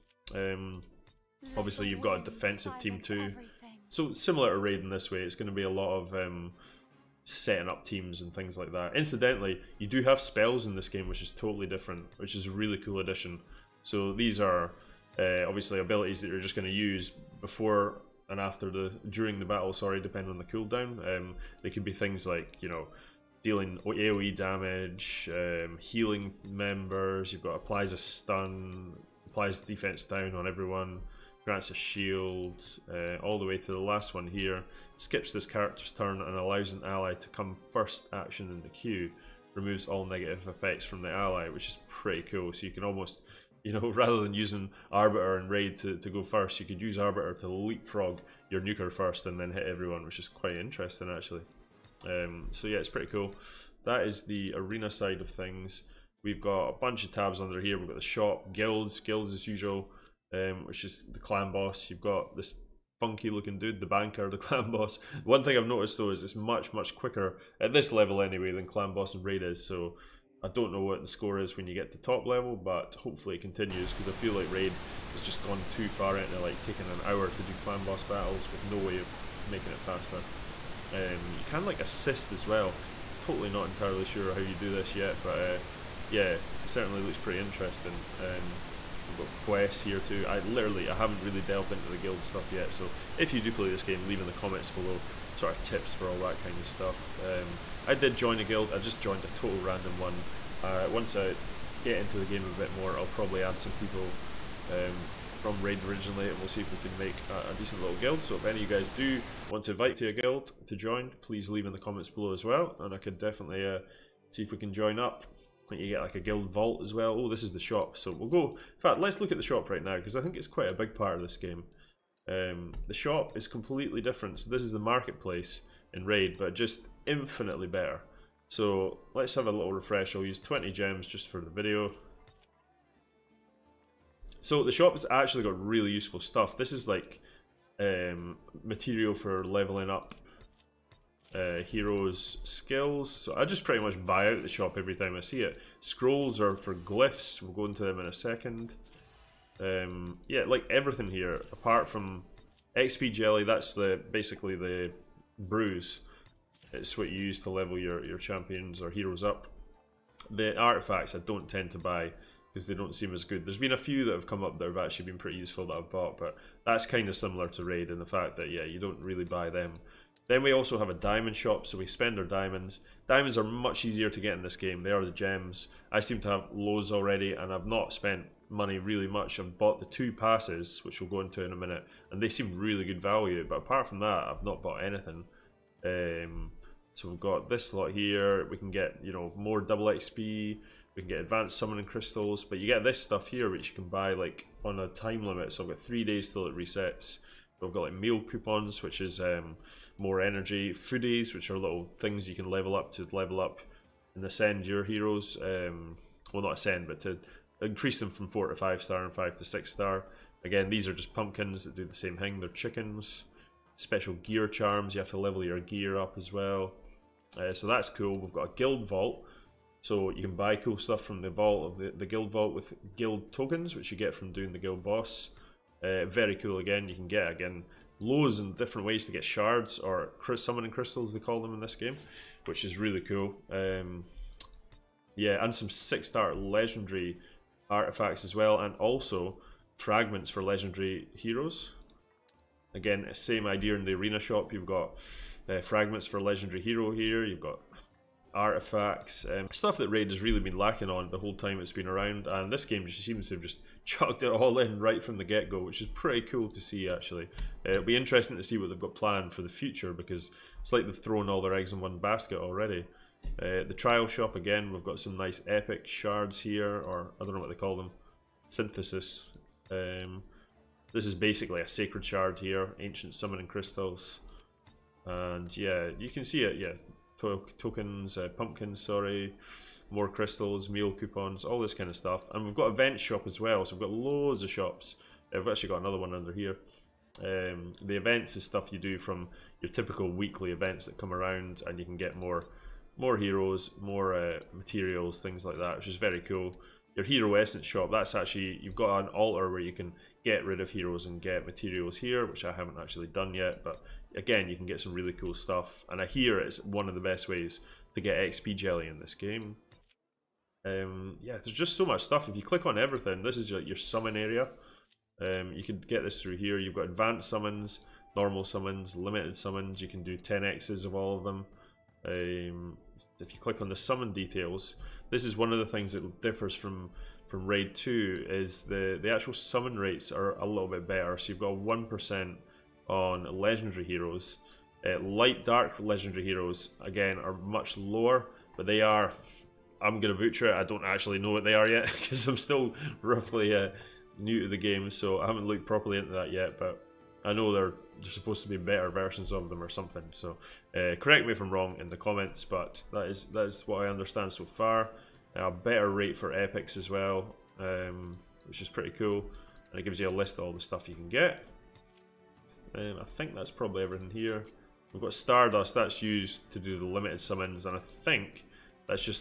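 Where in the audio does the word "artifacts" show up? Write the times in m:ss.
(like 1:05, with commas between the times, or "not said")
2:40, 3:57, 4:08.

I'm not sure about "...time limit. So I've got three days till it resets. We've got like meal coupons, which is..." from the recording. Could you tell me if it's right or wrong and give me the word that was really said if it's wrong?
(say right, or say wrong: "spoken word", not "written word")
right.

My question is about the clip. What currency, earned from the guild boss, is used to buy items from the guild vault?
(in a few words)
guild tokens.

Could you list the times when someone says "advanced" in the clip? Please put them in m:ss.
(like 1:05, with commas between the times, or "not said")
3:11, 5:16.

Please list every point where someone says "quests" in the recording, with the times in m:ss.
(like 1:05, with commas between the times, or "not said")
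1:29.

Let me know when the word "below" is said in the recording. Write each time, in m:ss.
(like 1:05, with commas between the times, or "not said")
1:34, 1:52.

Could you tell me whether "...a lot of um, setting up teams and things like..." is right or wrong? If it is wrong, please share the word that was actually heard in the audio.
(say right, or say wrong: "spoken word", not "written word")
right.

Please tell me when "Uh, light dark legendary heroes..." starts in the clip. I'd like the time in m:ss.
5:34.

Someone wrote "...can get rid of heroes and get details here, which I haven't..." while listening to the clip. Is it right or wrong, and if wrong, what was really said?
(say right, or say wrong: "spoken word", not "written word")
wrong: "materials", not "details".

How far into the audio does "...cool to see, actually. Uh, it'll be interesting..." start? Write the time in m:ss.
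4:16.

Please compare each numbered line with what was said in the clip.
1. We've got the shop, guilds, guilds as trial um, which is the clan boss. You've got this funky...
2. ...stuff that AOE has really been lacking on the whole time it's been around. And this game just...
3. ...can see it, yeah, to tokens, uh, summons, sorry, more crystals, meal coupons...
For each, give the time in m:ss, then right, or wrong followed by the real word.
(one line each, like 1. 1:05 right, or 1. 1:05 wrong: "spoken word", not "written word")
1. 0:57 wrong: "usual", not "trial"
2. 4:09 wrong: "Raid", not "AOE"
3. 4:36 wrong: "pumpkins", not "summons".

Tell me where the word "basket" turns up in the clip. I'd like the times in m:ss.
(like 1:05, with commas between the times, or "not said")
4:21.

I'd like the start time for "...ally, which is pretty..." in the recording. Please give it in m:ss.
0:41.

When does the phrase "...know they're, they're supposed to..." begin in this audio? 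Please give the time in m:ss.
5:47.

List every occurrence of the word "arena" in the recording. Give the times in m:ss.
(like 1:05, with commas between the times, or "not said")
0:54, 4:03.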